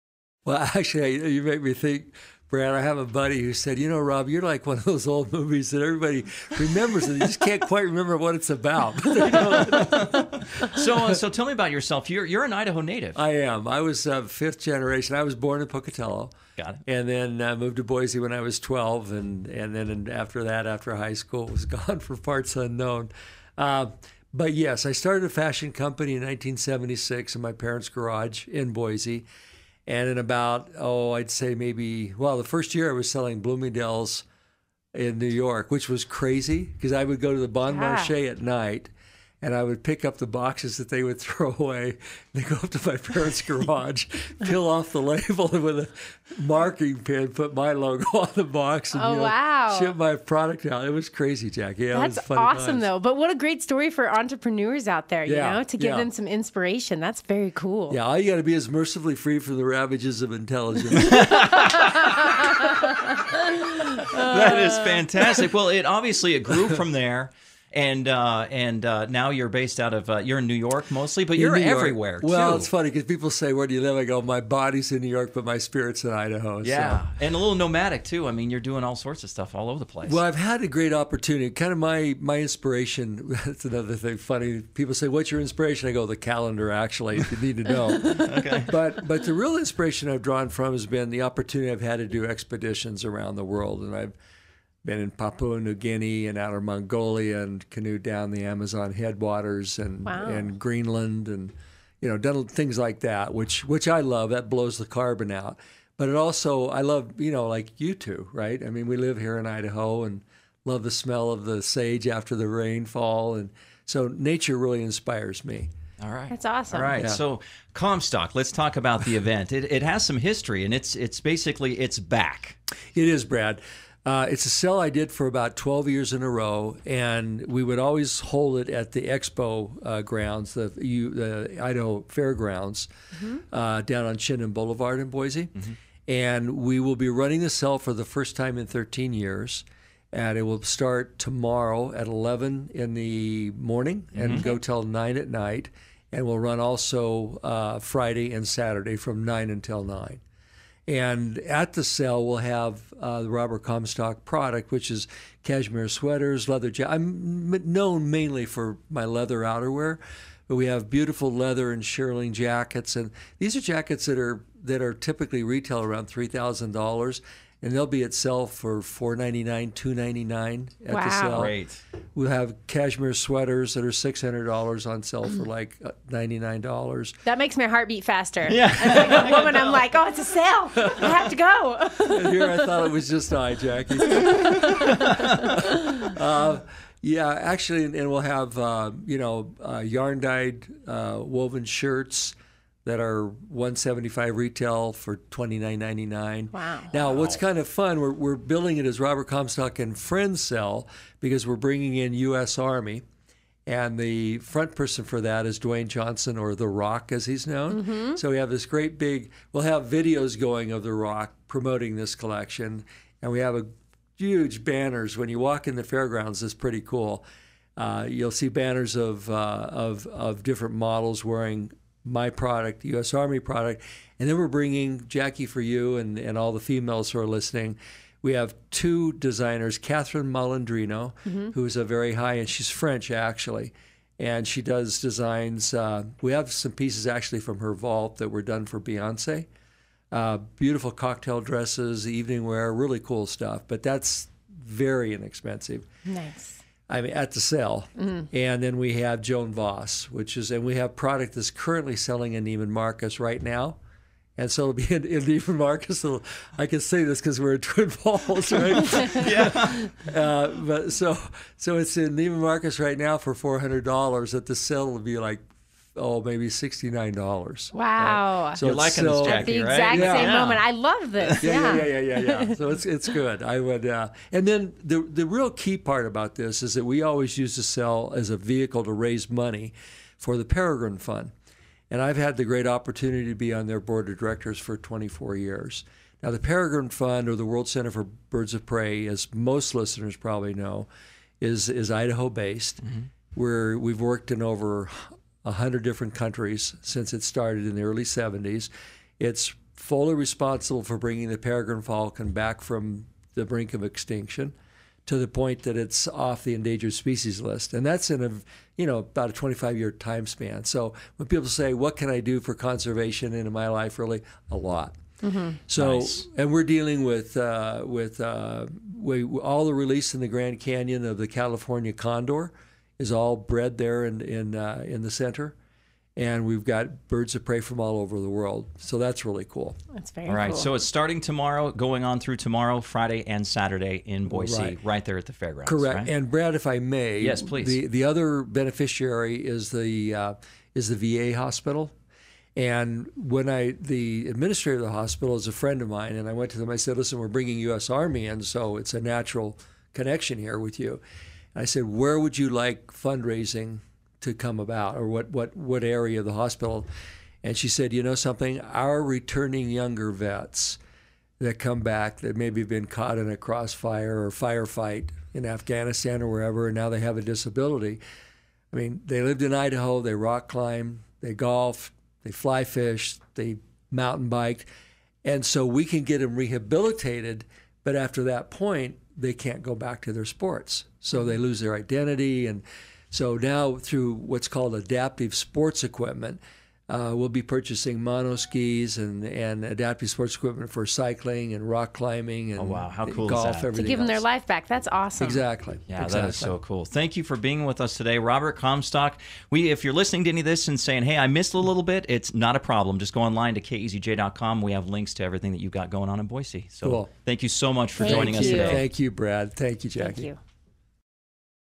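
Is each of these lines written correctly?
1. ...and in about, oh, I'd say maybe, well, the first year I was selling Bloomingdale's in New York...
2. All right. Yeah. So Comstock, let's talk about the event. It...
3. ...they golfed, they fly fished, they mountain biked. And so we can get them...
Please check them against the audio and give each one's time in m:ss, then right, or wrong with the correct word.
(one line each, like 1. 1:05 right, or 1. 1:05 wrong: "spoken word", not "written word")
1. 0:29 right
2. 1:56 right
3. 6:11 right.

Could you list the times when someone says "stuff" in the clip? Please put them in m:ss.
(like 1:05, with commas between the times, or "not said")
1:19, 4:03.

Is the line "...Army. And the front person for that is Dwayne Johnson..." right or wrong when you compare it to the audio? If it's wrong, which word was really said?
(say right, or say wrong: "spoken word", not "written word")
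right.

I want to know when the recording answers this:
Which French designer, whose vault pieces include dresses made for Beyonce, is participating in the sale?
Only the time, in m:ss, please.
3:49.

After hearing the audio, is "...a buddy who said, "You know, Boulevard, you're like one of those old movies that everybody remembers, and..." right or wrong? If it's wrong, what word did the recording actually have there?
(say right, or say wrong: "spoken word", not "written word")
wrong: "Rob", not "Boulevard".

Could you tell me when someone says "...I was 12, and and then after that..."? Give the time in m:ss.
0:18.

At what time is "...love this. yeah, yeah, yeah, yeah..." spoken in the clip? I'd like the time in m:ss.
4:30.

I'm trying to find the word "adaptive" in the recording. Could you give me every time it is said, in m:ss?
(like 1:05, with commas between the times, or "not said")
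6:24, 6:29.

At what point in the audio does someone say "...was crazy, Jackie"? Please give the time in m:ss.
0:50.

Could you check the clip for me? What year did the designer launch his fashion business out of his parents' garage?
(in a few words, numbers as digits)
1976.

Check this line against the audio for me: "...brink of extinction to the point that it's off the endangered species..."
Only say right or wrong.
right.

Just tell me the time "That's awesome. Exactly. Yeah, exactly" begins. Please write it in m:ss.
6:34.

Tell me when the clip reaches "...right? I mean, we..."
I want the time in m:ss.
1:48.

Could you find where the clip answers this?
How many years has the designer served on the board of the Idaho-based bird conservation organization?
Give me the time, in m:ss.
4:44.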